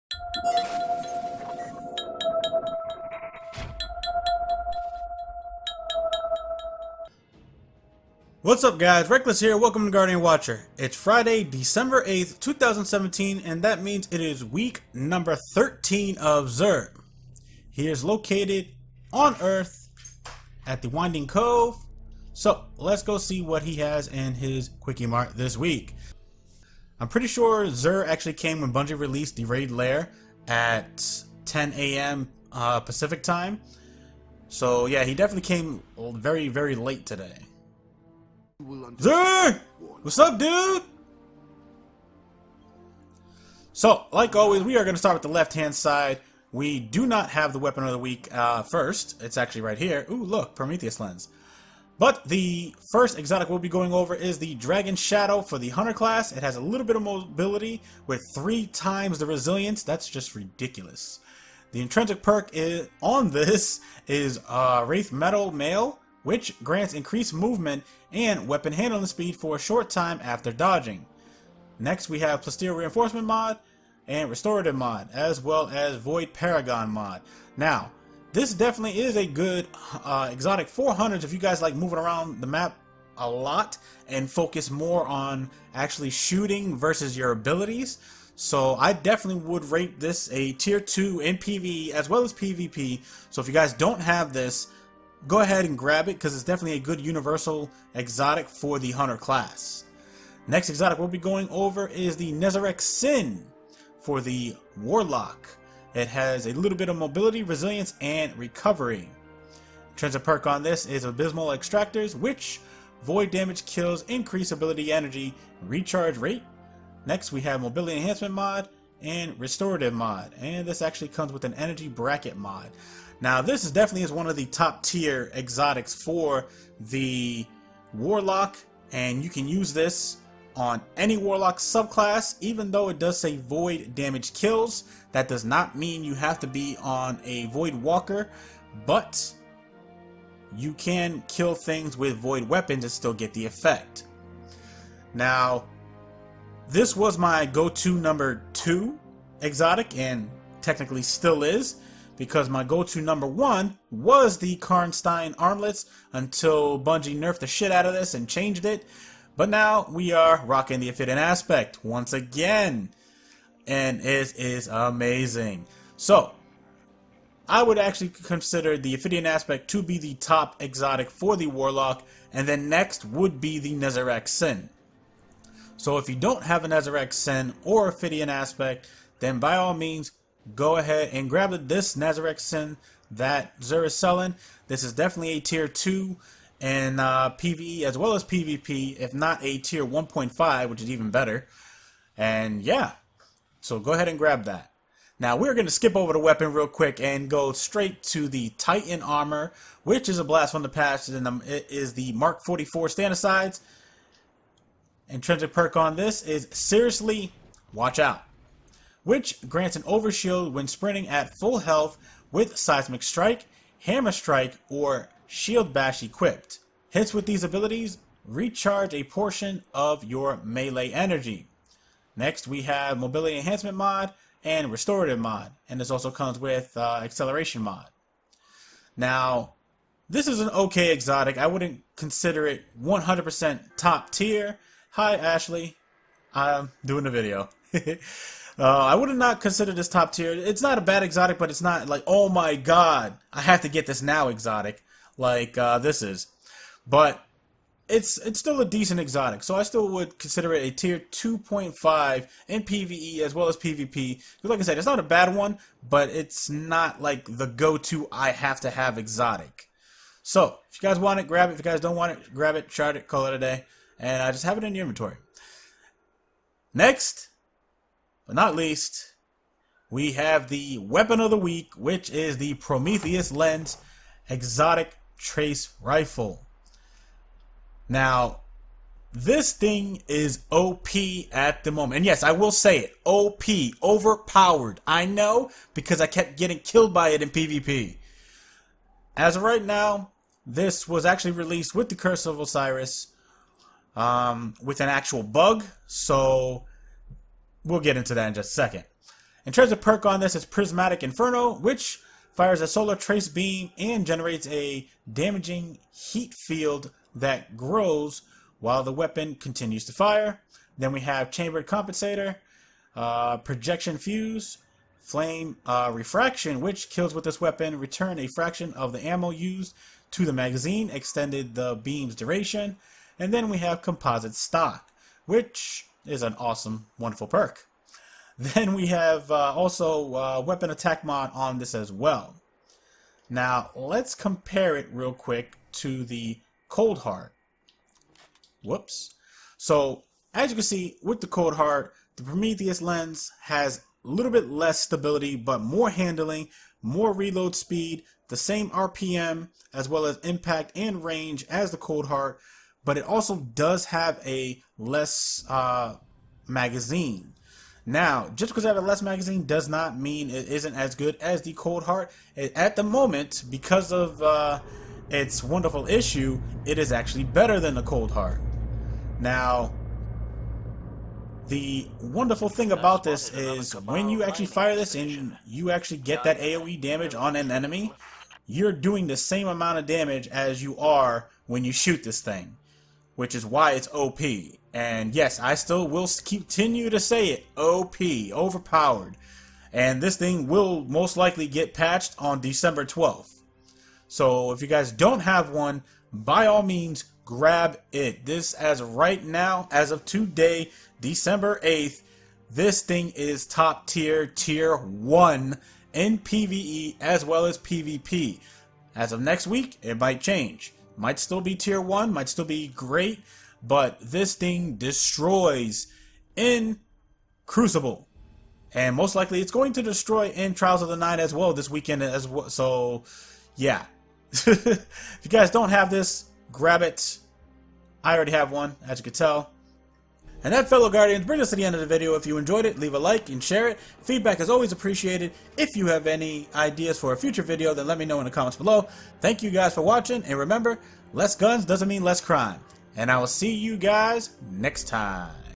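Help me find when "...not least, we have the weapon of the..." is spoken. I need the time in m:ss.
4:28.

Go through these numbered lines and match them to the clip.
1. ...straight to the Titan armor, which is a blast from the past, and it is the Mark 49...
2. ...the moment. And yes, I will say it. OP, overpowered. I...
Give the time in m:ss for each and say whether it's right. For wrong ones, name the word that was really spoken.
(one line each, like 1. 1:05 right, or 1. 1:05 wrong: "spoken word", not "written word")
1. 3:17 wrong: "44", not "49"
2. 4:41 right.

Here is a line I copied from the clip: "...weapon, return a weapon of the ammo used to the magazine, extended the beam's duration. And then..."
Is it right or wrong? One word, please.
wrong.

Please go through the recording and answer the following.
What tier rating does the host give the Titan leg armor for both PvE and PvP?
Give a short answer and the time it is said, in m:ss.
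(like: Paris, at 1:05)
2.5, at 4:10.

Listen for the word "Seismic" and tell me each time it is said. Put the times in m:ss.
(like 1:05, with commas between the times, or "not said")
3:32.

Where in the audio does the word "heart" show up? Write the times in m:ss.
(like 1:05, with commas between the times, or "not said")
5:36, 5:41, 5:52, 6:01, 6:08.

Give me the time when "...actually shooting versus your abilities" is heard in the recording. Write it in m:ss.
1:25.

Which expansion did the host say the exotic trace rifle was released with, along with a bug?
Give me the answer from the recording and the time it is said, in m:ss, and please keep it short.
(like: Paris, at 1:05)
Curse of Osiris, at 4:51.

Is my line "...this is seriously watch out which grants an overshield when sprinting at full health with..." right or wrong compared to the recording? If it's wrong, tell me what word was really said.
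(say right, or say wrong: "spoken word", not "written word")
right.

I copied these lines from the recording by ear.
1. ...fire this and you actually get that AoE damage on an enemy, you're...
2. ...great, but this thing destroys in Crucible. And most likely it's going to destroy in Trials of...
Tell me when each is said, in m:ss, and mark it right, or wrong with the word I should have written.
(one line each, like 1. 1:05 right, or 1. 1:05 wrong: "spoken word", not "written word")
1. 6:14 right
2. 6:52 right.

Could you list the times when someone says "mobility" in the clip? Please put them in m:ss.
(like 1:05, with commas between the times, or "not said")
0:57, 1:46, 1:57, 3:42.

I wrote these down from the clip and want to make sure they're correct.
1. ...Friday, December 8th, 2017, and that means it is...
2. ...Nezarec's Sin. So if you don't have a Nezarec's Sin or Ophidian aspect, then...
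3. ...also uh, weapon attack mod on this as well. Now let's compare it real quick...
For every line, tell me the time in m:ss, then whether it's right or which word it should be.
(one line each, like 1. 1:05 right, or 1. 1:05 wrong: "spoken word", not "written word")
1. 0:10 right
2. 2:53 right
3. 5:29 right.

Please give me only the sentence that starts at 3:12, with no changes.
And yeah, so go ahead and grab that.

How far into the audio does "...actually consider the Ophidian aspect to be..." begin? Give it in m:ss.
2:47.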